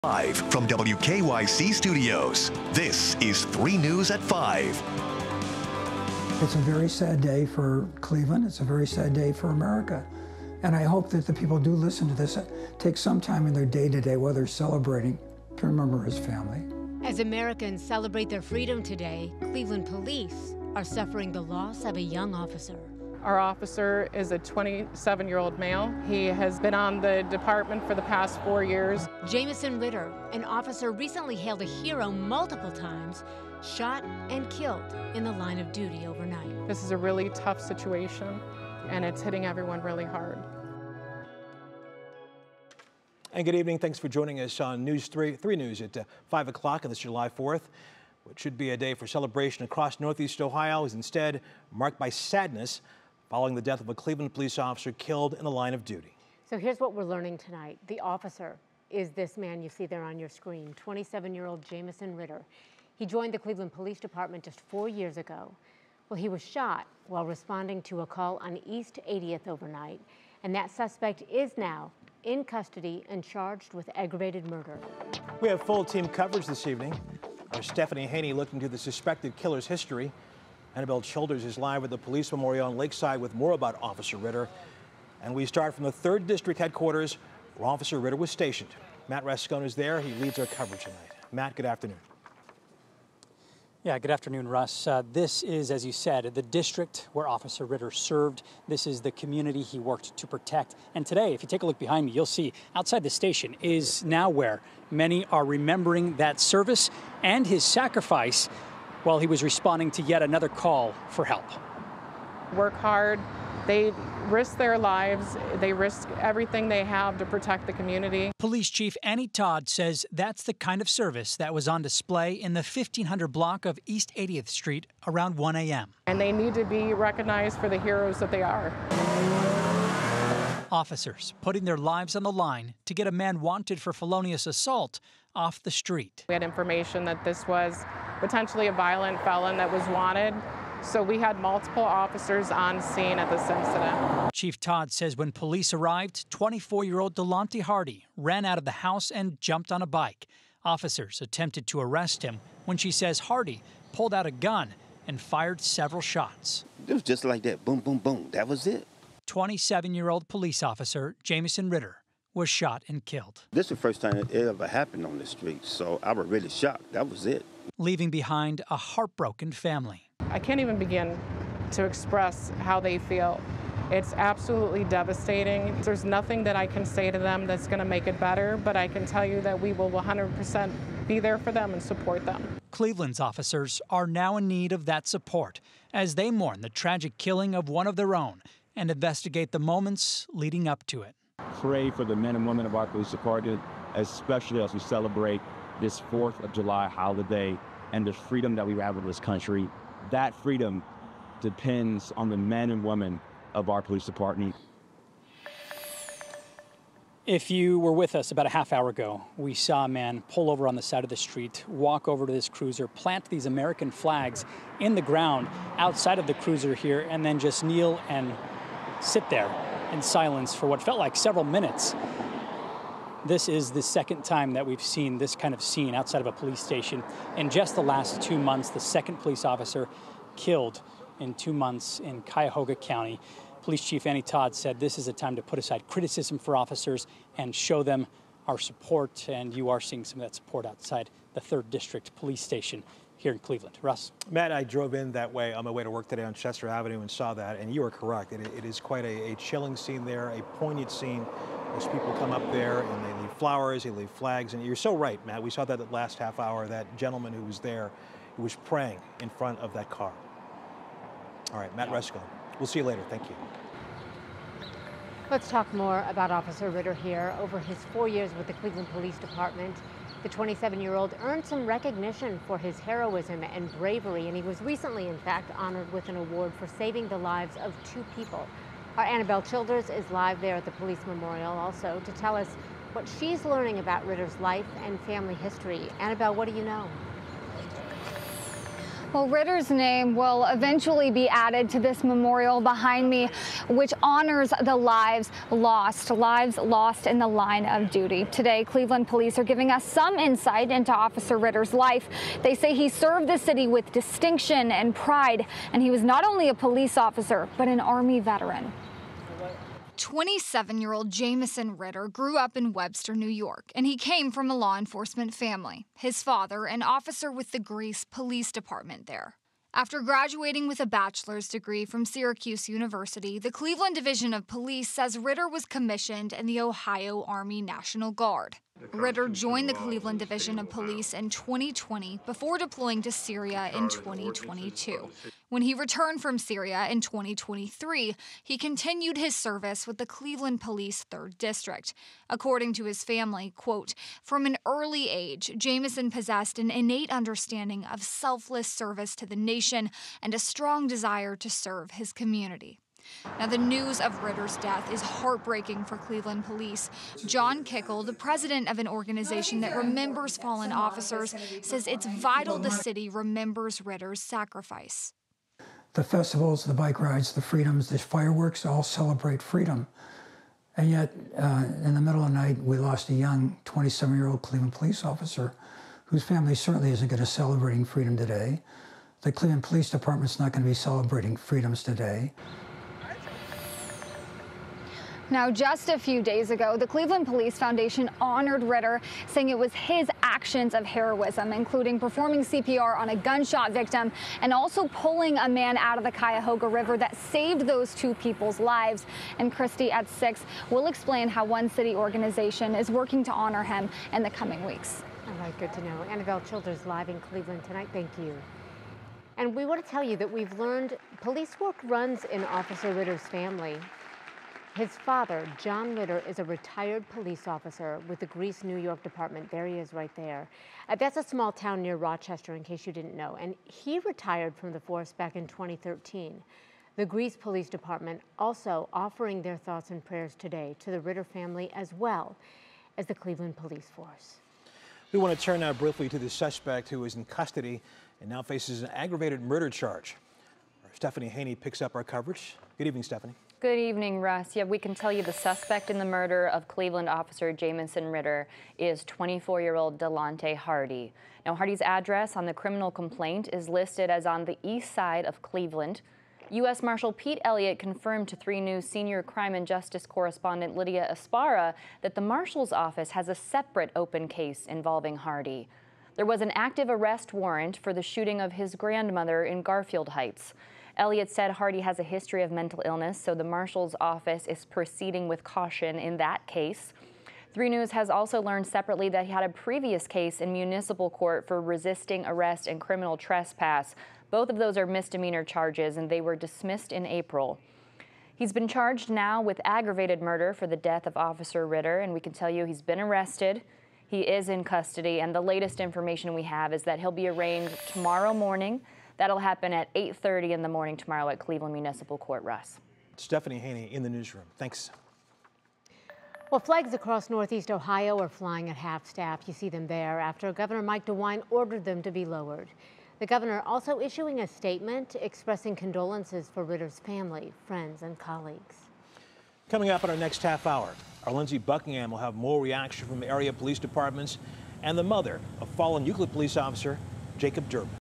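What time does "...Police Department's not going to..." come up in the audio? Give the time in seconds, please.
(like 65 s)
379 s.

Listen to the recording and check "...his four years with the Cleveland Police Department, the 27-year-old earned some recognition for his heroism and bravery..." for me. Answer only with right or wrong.
right.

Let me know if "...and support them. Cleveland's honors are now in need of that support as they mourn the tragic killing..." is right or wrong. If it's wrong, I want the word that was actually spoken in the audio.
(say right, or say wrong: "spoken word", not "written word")
wrong: "officers", not "honors".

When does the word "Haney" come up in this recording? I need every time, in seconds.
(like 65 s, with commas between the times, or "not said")
78 s, 441 s, 503 s.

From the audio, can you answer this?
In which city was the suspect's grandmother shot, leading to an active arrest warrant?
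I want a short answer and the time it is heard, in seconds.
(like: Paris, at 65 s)
Garfield Heights, at 469 s.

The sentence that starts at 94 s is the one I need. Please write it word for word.
Uh, this is, as you said, the district where Officer Ritter served.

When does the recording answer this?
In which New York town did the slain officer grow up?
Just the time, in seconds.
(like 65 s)
312 s.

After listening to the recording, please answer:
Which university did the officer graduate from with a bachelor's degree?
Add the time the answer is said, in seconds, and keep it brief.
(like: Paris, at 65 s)
Syracuse University, at 322 s.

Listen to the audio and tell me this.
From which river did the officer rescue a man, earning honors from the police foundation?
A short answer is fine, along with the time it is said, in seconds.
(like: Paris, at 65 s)
Cuyahoga River, at 396 s.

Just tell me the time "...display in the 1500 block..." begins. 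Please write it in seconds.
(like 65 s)
121 s.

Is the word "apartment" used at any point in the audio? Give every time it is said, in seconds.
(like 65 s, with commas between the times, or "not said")
not said.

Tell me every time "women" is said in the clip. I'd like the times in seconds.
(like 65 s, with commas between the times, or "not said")
192 s, 202 s.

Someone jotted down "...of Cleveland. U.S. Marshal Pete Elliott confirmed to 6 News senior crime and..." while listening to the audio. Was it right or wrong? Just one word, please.
wrong.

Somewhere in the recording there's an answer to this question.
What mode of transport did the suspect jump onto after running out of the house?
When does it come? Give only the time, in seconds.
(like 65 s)
149 s.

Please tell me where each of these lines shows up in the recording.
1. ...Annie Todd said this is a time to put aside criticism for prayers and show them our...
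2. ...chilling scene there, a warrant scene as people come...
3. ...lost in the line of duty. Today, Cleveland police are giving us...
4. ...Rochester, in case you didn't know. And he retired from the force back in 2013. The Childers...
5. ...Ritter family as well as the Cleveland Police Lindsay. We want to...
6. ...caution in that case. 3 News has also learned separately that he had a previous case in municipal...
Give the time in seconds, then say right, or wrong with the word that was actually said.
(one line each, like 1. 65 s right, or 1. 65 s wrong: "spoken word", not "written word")
1. 234 s wrong: "officers", not "prayers"
2. 249 s wrong: "poignant", not "warrant"
3. 296 s right
4. 421 s wrong: "Greece", not "Childers"
5. 431 s wrong: "Force", not "Lindsay"
6. 475 s right.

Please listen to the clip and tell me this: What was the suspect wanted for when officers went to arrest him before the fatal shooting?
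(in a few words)
felonious assault.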